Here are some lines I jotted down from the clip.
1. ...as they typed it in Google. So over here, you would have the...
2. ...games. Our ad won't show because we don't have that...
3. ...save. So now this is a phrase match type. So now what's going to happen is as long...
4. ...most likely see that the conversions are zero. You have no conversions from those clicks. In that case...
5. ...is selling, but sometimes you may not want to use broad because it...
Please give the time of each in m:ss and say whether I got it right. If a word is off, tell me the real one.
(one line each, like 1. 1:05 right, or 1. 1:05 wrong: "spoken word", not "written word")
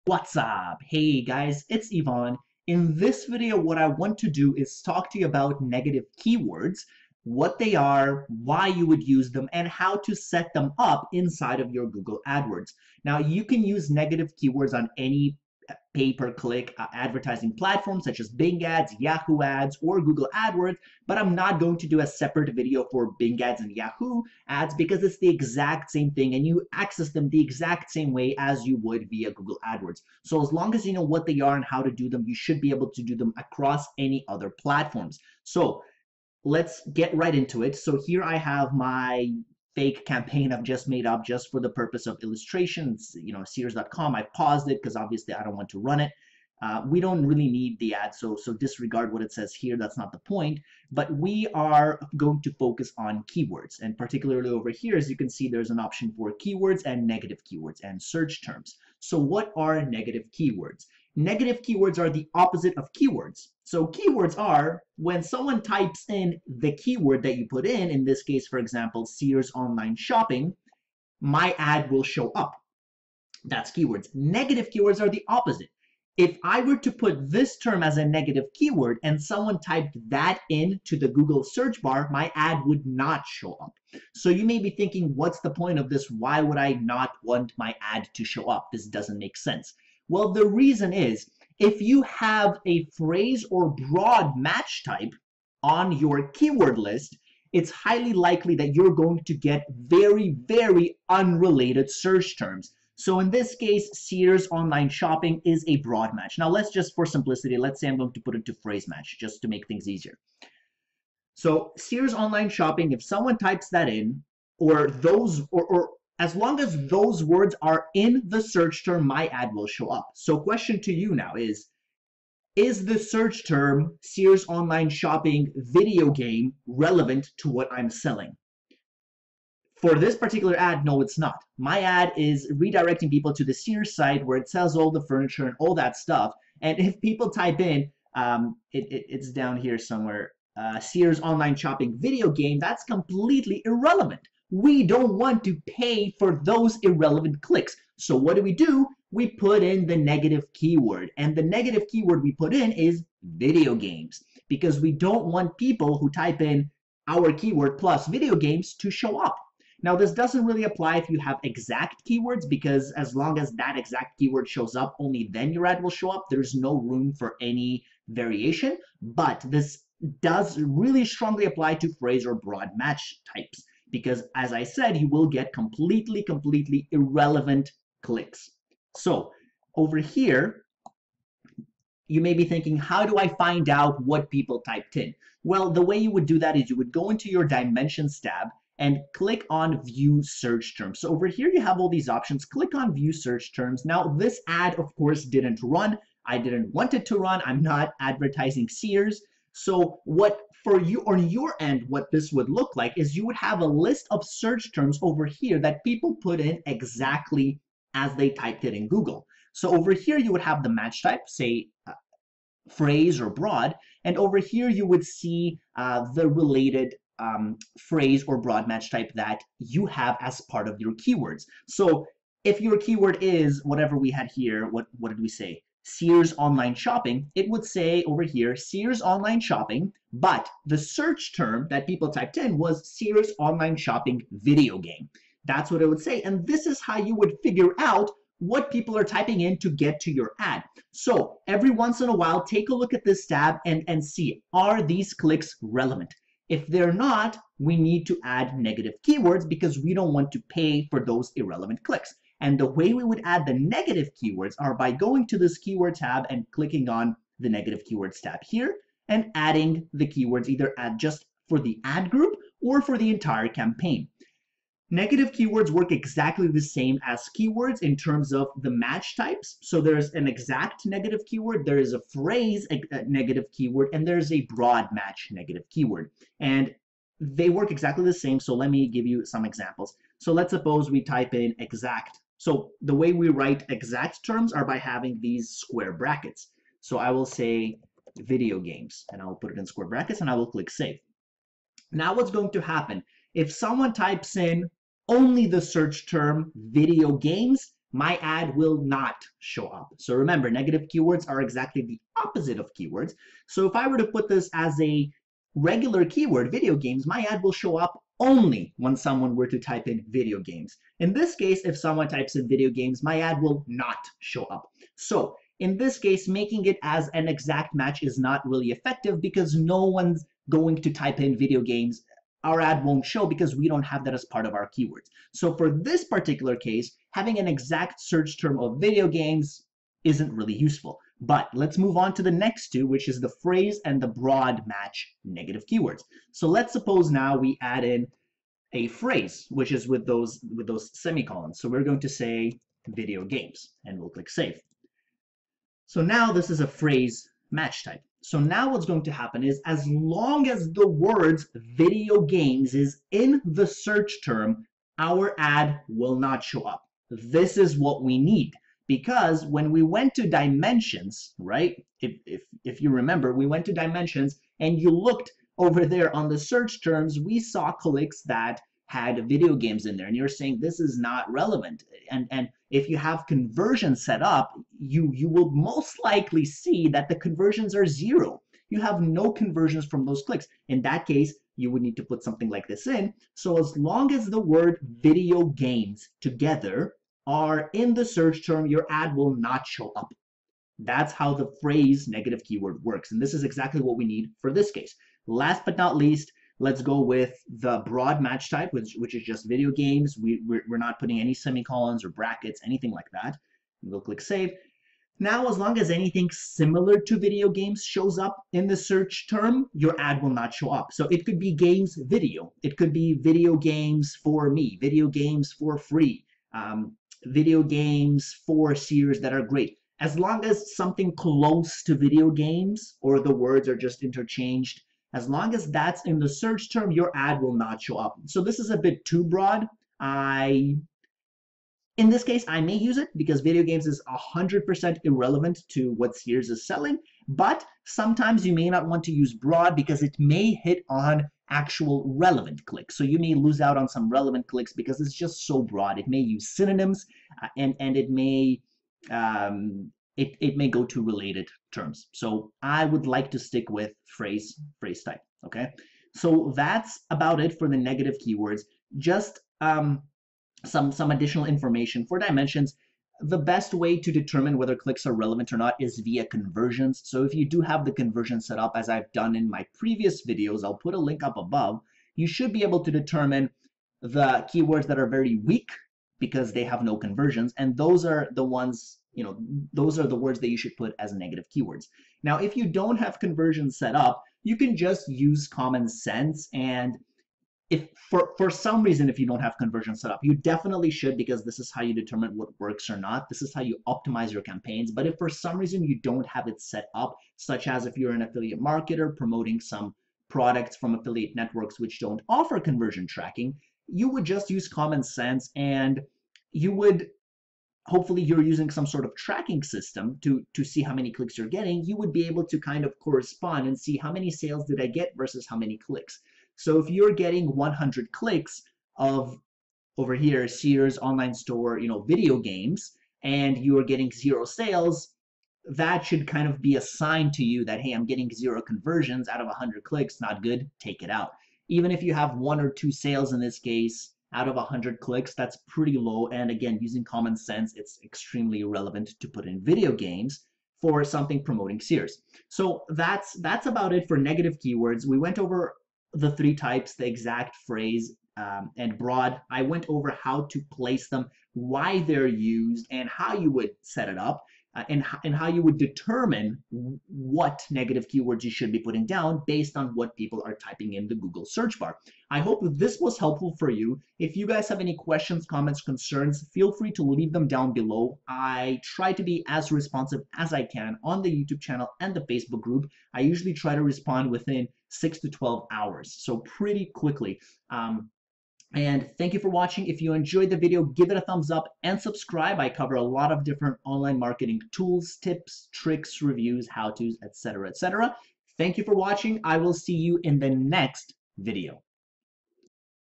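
1. 3:27 right
2. 5:21 right
3. 5:44 right
4. 6:15 right
5. 7:16 right.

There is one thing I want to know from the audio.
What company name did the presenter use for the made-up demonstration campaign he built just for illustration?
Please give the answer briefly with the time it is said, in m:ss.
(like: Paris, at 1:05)
Sears.com, at 0:43.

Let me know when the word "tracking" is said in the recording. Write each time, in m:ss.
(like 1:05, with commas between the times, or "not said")
8:23, 8:29.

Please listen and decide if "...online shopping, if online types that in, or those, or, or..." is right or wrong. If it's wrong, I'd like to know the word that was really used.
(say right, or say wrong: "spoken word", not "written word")
wrong: "someone", not "online".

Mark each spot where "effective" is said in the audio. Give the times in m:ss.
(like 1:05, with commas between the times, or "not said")
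5:18.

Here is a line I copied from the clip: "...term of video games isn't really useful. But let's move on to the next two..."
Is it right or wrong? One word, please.
right.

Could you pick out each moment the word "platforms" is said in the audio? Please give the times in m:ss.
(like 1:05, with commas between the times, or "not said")
0:17, 0:34.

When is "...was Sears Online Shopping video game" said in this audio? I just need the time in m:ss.
3:52.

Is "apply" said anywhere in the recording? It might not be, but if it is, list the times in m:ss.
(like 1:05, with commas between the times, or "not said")
2:40, 2:51.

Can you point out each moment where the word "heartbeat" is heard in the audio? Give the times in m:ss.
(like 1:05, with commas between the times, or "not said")
not said.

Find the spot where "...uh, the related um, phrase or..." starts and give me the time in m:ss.
3:35.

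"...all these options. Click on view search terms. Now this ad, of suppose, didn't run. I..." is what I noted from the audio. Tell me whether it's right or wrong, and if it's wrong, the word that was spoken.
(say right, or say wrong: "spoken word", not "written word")
wrong: "course", not "suppose".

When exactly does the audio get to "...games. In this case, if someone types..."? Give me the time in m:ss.
5:10.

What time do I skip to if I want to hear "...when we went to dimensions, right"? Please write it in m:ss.
5:59.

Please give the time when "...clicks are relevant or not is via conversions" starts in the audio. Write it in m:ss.
7:44.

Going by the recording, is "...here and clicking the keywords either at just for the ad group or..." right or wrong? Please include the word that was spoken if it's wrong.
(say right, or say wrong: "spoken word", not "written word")
wrong: "adding", not "clicking".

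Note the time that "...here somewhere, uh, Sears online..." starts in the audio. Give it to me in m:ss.
2:19.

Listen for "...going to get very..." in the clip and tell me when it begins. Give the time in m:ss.
1:38.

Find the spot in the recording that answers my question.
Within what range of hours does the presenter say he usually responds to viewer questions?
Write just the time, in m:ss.
9:34.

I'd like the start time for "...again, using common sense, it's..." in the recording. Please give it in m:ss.
8:56.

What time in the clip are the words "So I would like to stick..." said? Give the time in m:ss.
7:32.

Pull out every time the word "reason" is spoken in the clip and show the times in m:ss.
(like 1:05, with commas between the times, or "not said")
1:30, 8:08, 8:15.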